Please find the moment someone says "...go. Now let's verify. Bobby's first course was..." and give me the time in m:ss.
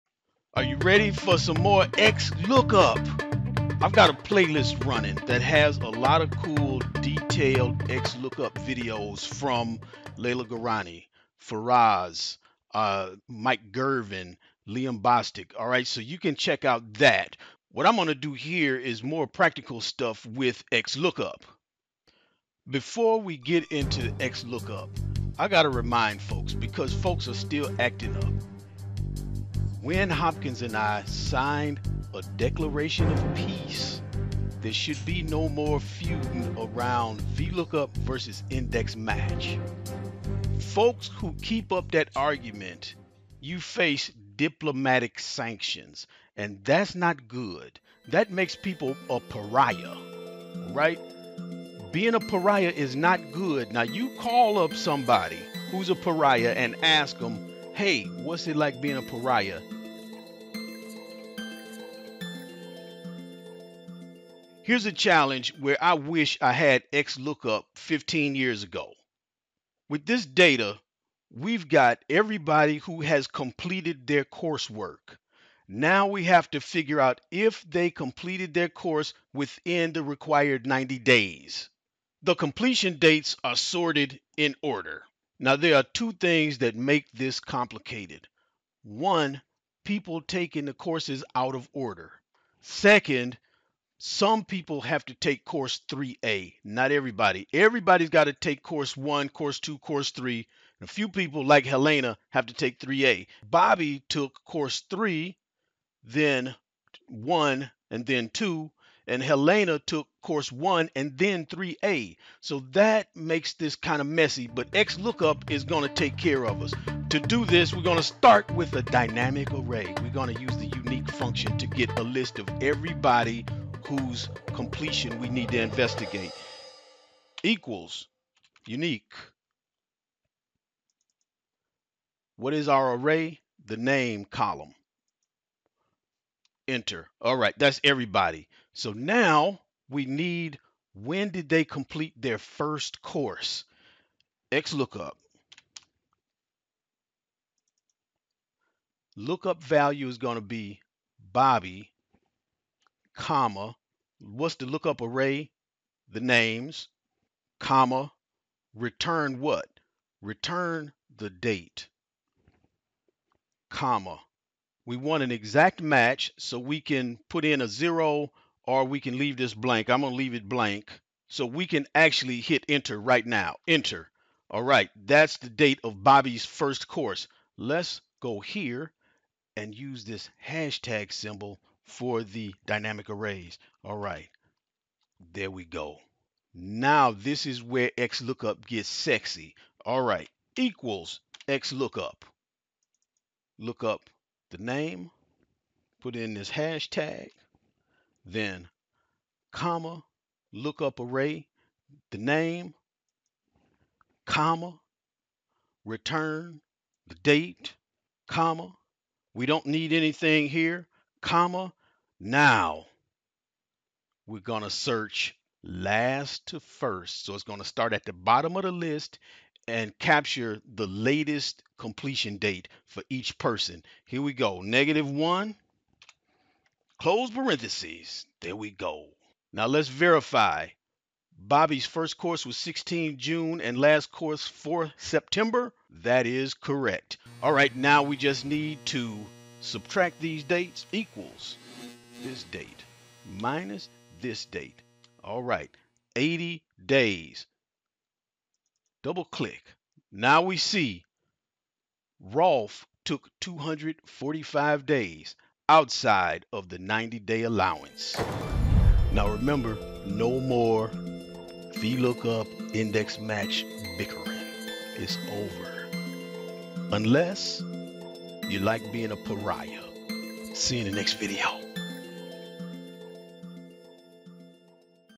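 3:48.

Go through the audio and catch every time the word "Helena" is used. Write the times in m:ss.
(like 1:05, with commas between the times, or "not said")
1:41, 1:49.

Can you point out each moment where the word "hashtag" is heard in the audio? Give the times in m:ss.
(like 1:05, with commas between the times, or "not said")
3:00, 3:16.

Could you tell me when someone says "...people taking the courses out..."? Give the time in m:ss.
1:29.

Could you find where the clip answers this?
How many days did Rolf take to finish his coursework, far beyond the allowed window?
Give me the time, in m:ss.
4:13.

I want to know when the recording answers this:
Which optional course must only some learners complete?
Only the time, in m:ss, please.
1:35.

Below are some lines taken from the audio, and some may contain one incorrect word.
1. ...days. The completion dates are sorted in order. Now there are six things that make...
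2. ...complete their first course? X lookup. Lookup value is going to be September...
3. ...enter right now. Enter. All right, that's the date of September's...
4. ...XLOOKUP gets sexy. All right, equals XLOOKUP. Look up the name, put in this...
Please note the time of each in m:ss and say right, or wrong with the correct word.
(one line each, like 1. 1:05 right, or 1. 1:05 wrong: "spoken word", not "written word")
1. 1:20 wrong: "two", not "six"
2. 2:21 wrong: "Bobby", not "September"
3. 2:52 wrong: "Bobby", not "September"
4. 3:07 right.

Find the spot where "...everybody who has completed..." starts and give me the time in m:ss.
1:12.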